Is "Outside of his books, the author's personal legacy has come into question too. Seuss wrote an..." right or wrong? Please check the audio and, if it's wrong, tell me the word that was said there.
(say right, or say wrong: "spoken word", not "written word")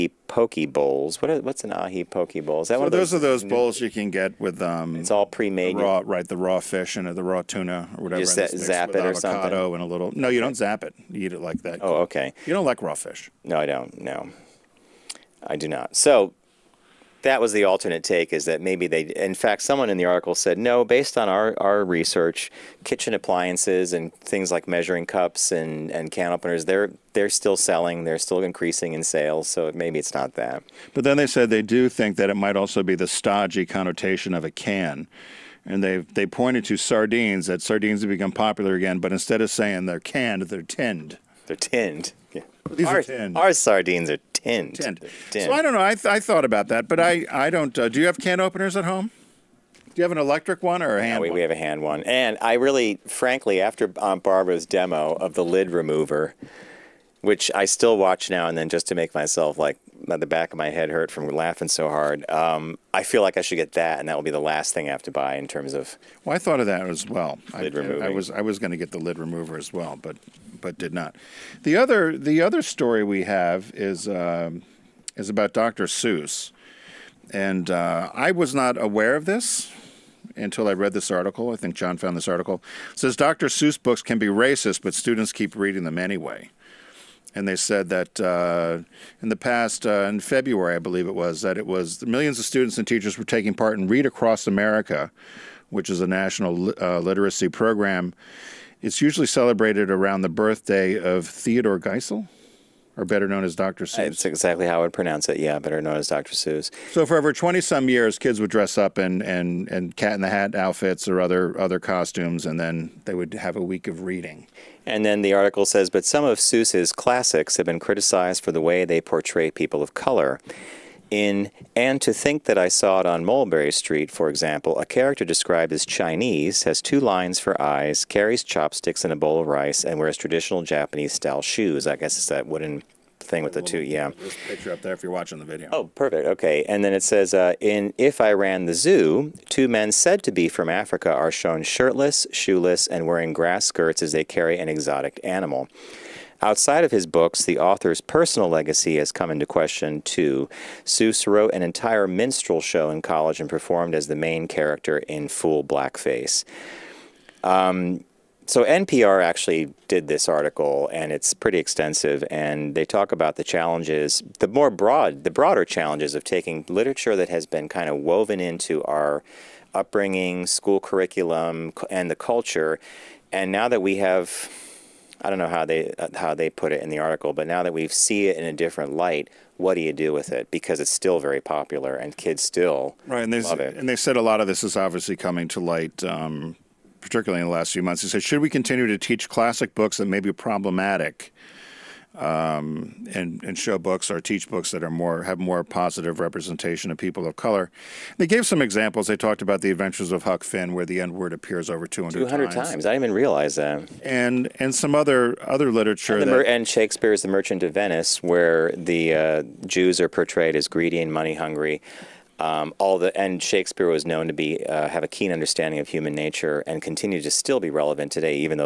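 right.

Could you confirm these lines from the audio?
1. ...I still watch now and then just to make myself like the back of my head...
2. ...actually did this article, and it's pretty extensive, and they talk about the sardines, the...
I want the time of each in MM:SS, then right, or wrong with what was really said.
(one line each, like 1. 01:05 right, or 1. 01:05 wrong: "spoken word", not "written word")
1. 00:57 right
2. 02:39 wrong: "challenges", not "sardines".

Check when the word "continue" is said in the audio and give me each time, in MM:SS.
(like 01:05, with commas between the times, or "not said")
03:08, 03:36.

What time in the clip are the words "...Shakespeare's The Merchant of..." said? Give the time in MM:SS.
03:26.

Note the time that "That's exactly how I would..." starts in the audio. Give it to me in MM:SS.
01:43.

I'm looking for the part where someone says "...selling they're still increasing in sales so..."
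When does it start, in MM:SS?
00:27.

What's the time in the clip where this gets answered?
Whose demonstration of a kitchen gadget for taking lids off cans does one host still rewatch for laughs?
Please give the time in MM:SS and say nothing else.
00:53.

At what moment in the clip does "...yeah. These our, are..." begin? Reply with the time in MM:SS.
00:42.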